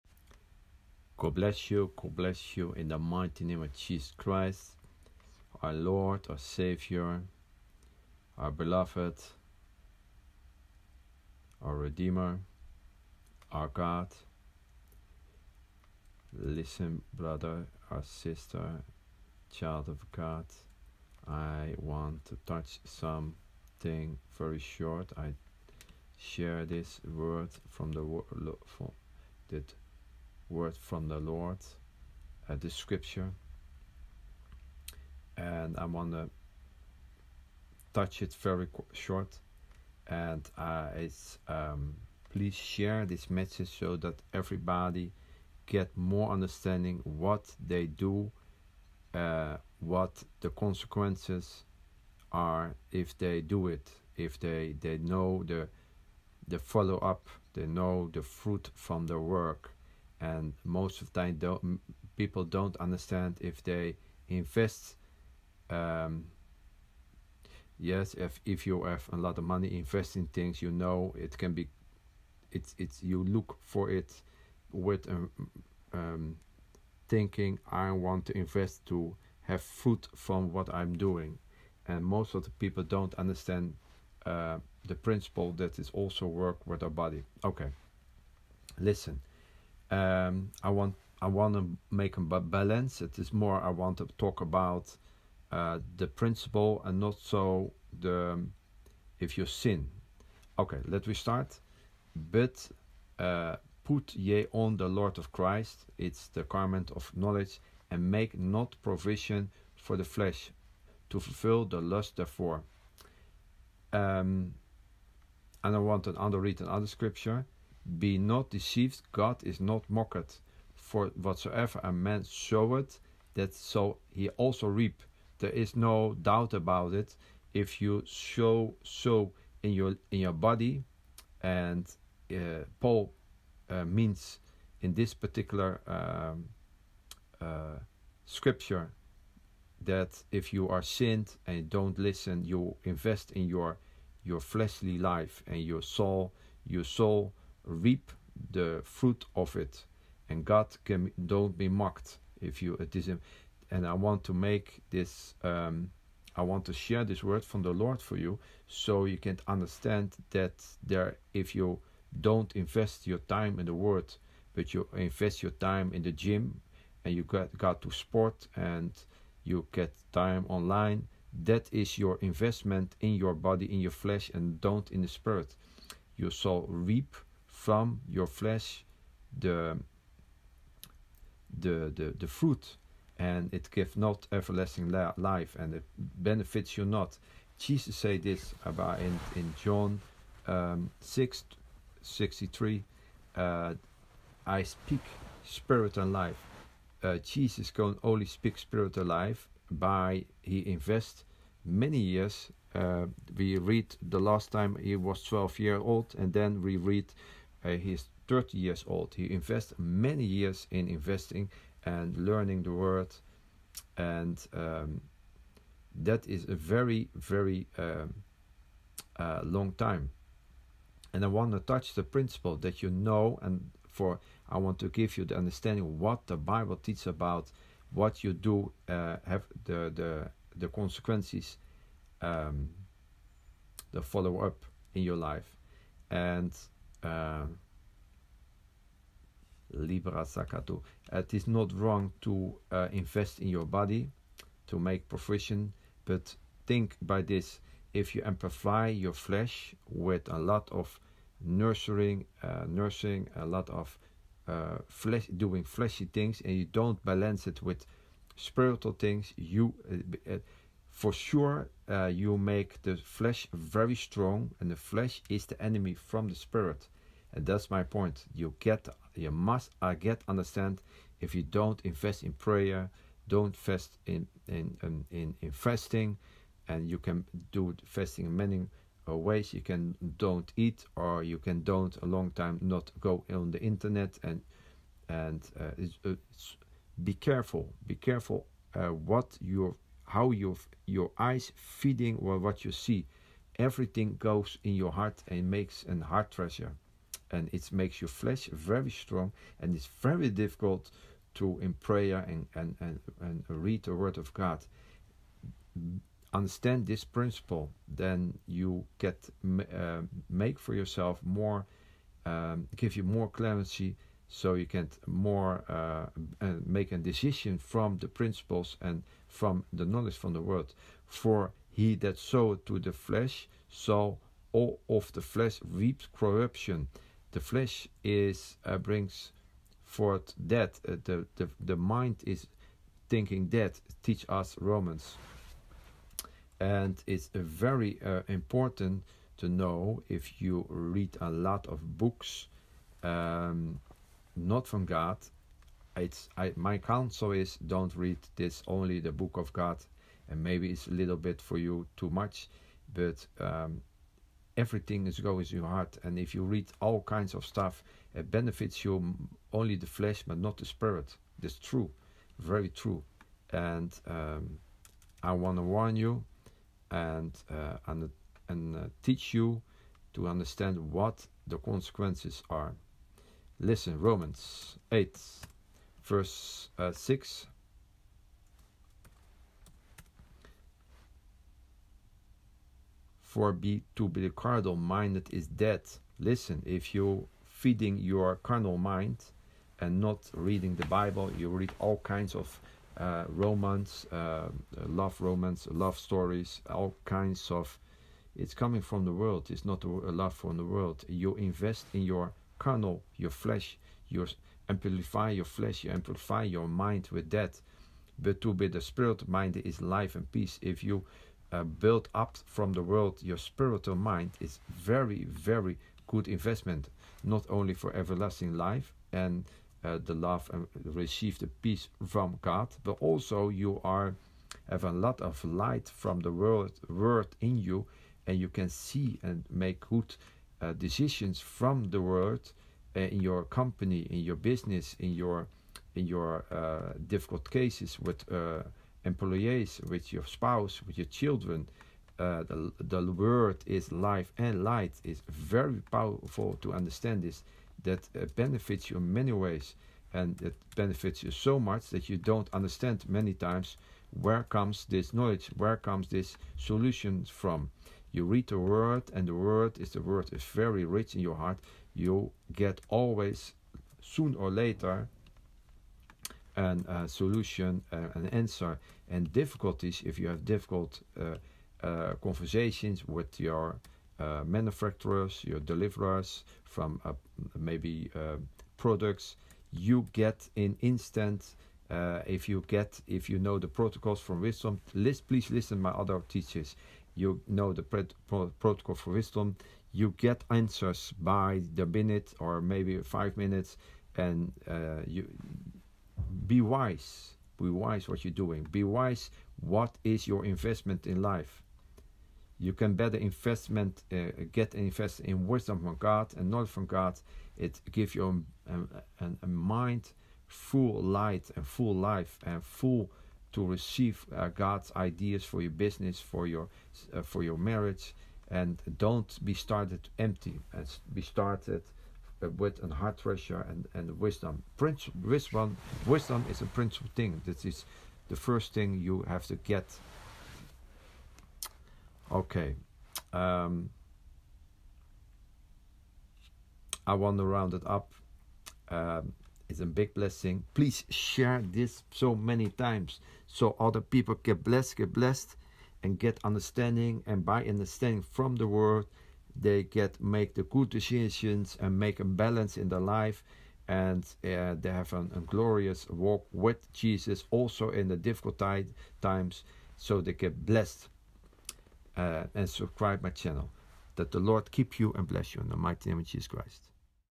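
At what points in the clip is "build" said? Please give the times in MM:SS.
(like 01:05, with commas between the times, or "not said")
06:51.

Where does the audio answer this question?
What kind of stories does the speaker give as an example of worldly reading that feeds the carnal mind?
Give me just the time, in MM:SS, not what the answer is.
06:35.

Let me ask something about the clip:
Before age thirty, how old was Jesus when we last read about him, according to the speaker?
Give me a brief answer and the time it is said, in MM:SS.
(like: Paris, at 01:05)
12, at 03:25.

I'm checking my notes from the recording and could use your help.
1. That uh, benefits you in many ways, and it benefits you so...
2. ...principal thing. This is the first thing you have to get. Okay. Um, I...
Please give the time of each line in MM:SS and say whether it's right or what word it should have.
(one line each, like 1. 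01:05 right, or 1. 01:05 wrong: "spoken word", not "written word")
1. 07:27 right
2. 08:46 right.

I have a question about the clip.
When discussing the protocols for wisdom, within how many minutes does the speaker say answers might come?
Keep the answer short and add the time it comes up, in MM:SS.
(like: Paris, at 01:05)
5, at 08:12.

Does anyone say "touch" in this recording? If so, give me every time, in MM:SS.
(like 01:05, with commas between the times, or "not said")
00:22, 00:37, 03:41.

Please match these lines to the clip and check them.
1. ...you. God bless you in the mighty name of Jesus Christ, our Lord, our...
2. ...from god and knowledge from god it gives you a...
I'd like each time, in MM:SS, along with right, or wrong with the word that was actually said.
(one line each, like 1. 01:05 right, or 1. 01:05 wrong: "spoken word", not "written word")
1. 00:01 right
2. 08:25 right.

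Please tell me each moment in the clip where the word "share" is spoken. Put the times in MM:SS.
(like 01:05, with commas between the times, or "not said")
00:26, 00:42, 02:36, 09:01.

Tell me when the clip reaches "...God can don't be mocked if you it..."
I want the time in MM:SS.
02:30.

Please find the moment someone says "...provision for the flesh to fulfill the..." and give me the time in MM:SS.
01:48.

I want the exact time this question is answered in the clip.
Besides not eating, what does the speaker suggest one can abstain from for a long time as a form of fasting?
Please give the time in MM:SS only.
04:43.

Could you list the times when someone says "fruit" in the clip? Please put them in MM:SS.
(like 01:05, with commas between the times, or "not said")
00:58, 02:28, 03:02.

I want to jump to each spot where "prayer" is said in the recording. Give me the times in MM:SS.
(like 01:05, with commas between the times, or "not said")
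04:32, 05:01.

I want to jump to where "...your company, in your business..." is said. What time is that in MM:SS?
07:13.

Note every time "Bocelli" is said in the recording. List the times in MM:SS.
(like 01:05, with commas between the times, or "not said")
not said.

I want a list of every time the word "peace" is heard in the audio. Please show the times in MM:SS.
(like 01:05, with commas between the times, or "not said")
06:50, 07:01.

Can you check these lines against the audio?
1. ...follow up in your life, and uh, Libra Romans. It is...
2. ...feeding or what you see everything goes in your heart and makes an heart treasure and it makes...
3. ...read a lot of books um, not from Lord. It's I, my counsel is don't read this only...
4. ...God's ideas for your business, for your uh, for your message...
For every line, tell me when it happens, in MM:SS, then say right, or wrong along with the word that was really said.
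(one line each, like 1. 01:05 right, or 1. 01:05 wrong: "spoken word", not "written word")
1. 03:54 wrong: "Sakatu", not "Romans"
2. 04:51 right
3. 05:40 wrong: "God", not "Lord"
4. 08:34 wrong: "marriage", not "message".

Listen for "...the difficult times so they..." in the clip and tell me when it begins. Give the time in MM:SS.
09:18.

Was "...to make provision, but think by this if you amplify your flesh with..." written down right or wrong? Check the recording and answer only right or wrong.
right.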